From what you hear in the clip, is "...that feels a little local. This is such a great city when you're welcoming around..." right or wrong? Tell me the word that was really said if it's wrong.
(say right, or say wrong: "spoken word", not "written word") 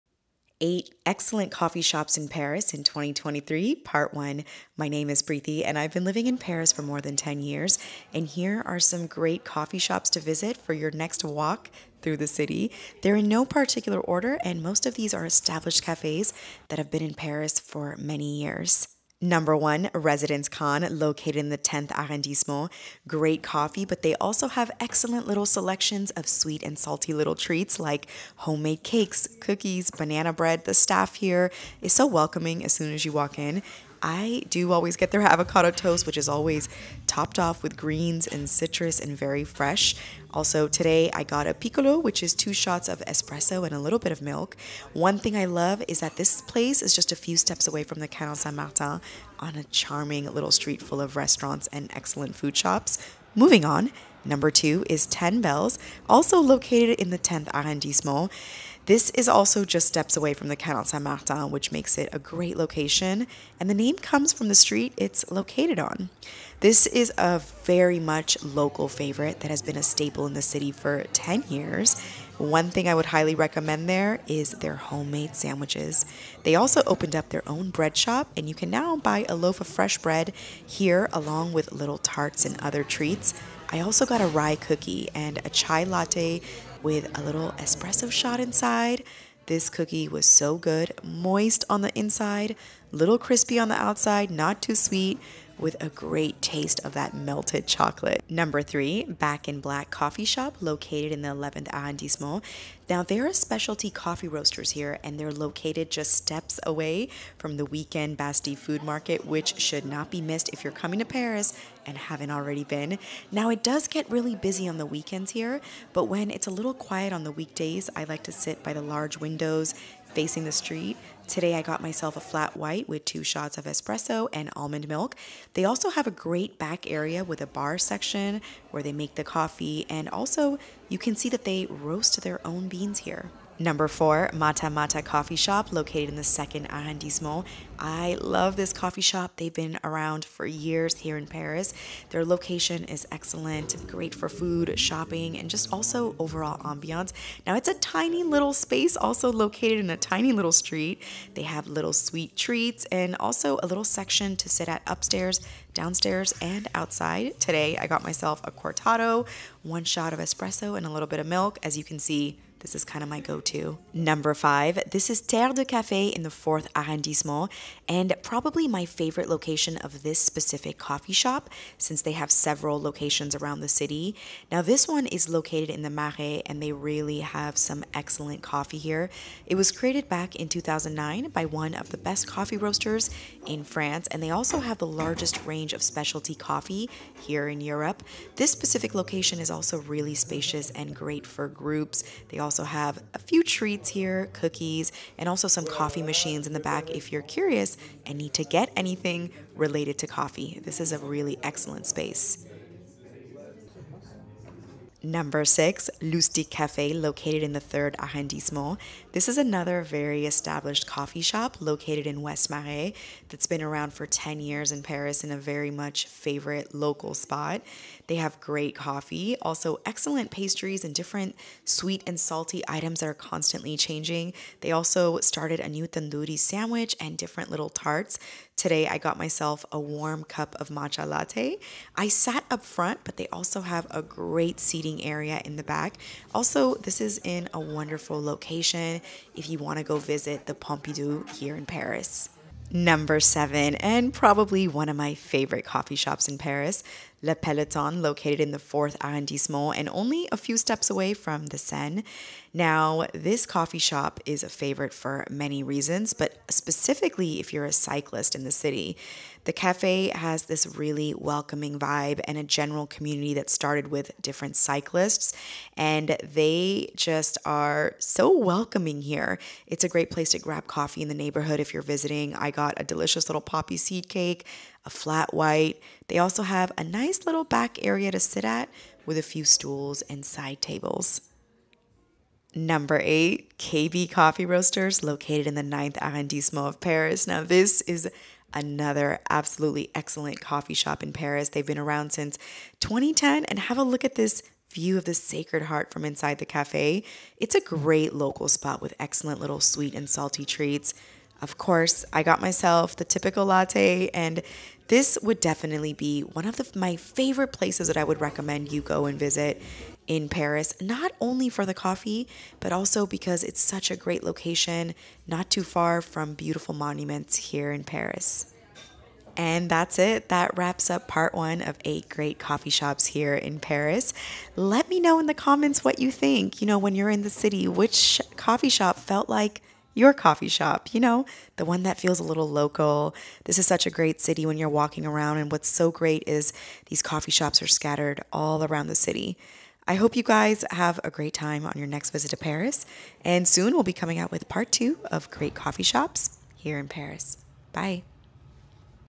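wrong: "walking", not "welcoming".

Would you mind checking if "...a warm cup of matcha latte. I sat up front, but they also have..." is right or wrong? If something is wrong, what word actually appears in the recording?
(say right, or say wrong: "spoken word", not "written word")
right.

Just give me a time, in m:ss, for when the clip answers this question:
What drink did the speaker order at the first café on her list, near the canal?
0:41.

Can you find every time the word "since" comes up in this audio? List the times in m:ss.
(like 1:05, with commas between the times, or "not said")
2:51, 4:52.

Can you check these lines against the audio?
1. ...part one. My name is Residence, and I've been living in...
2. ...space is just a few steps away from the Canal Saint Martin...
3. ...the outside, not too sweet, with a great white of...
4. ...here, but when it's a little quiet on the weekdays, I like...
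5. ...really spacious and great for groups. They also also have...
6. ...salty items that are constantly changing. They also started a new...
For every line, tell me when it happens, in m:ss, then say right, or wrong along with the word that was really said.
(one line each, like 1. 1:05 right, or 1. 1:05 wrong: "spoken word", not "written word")
1. 0:03 wrong: "Preeti", not "Residence"
2. 0:46 wrong: "place", not "space"
3. 1:33 wrong: "taste", not "white"
4. 1:55 right
5. 3:09 right
6. 3:42 right.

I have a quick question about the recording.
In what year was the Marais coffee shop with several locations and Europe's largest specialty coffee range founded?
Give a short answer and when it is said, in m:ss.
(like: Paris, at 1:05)
2009, at 3:00.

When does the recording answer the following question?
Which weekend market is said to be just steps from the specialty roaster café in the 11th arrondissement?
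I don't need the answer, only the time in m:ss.
1:48.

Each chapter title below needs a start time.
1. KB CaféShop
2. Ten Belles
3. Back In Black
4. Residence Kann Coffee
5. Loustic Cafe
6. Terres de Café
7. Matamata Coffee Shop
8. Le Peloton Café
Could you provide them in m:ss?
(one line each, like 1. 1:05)
1. 4:43
2. 0:53
3. 1:37
4. 0:19
5. 3:25
6. 2:44
7. 2:13
8. 4:02.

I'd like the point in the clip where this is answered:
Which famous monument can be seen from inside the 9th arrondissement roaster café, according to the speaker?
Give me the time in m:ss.
4:55.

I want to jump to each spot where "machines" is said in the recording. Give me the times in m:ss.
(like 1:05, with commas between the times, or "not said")
3:16.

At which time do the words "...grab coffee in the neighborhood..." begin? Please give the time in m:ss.
4:30.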